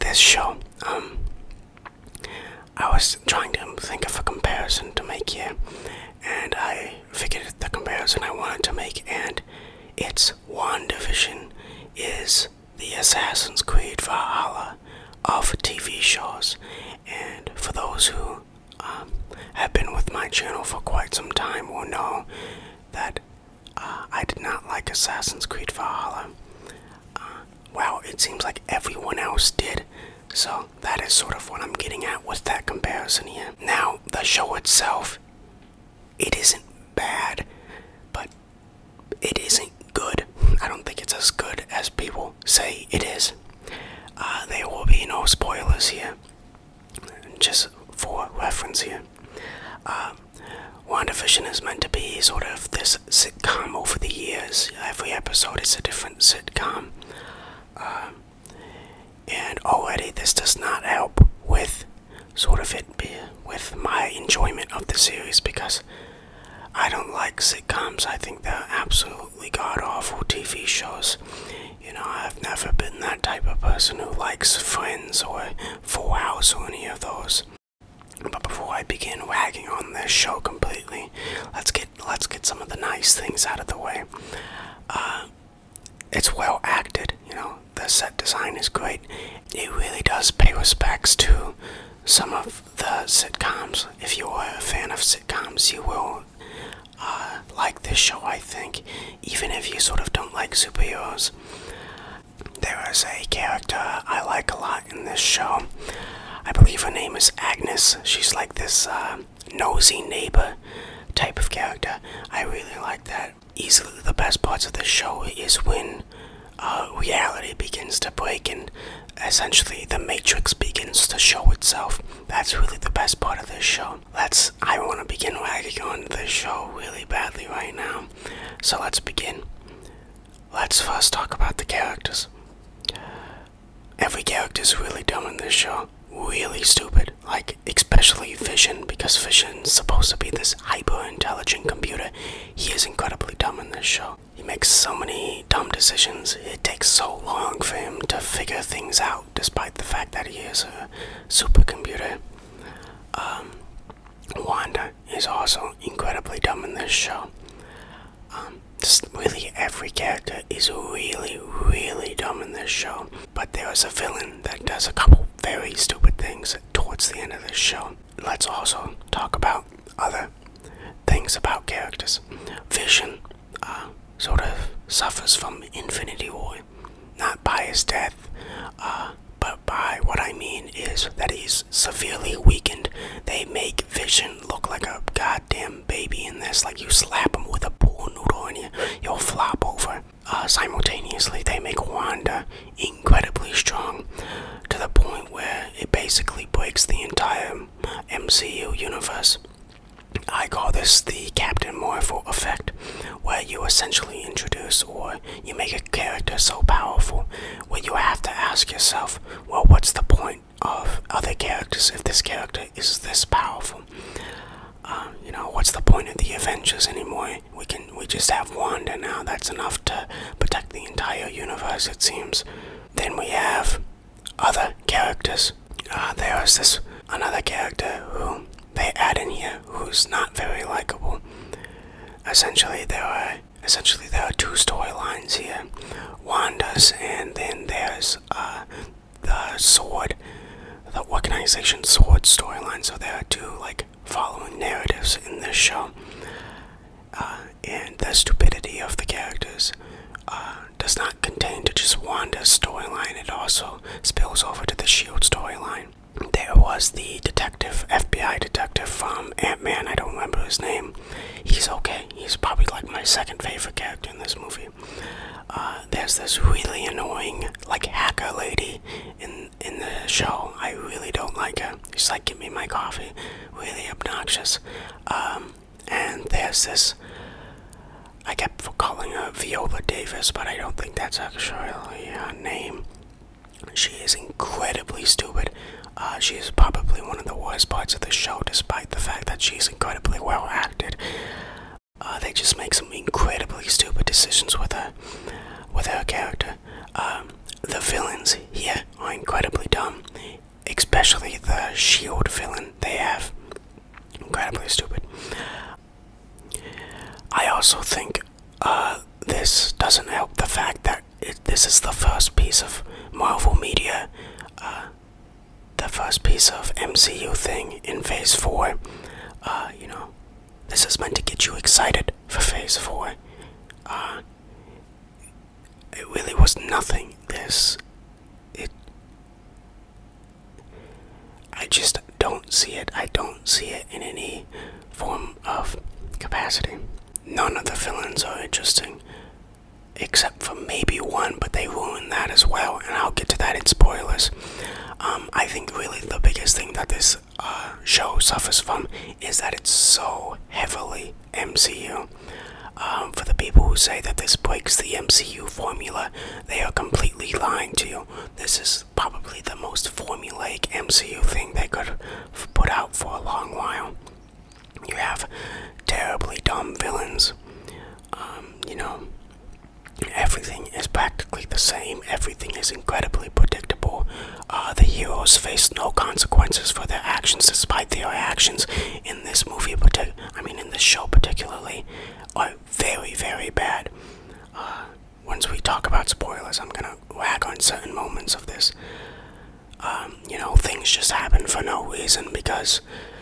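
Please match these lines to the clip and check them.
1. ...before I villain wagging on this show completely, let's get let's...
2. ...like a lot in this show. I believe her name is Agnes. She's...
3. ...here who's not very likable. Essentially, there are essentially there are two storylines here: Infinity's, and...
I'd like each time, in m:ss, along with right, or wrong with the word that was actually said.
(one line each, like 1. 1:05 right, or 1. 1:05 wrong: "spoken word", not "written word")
1. 1:18 wrong: "begin", not "villain"
2. 1:44 right
3. 3:49 wrong: "Wanda", not "Infinity".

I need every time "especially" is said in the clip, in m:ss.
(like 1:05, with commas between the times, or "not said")
2:17, 5:00.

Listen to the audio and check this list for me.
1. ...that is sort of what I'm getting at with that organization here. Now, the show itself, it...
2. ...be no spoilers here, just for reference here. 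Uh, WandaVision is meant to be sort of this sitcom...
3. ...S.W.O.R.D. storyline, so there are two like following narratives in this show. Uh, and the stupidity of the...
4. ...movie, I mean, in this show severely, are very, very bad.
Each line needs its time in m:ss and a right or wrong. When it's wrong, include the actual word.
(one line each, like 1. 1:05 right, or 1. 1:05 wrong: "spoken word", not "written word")
1. 0:30 wrong: "comparison", not "organization"
2. 0:44 right
3. 4:01 right
4. 6:19 wrong: "particularly", not "severely".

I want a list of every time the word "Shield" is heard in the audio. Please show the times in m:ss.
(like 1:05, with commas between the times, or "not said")
4:14, 5:01.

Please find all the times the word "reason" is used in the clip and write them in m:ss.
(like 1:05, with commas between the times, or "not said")
6:31.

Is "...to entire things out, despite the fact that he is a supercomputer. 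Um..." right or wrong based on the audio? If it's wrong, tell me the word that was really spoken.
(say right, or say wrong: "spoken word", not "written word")
wrong: "figure", not "entire".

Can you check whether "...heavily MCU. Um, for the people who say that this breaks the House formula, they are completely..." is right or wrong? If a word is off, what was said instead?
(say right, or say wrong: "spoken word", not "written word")
wrong: "MCU", not "House".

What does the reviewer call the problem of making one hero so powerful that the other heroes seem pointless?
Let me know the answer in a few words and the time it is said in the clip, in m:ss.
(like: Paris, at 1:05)
The Captain Marvel effect, at 3:21.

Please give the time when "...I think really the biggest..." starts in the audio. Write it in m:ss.
5:45.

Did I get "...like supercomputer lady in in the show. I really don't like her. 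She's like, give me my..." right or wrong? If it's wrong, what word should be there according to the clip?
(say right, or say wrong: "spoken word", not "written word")
wrong: "hacker", not "supercomputer".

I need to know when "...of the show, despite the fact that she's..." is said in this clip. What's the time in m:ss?
4:47.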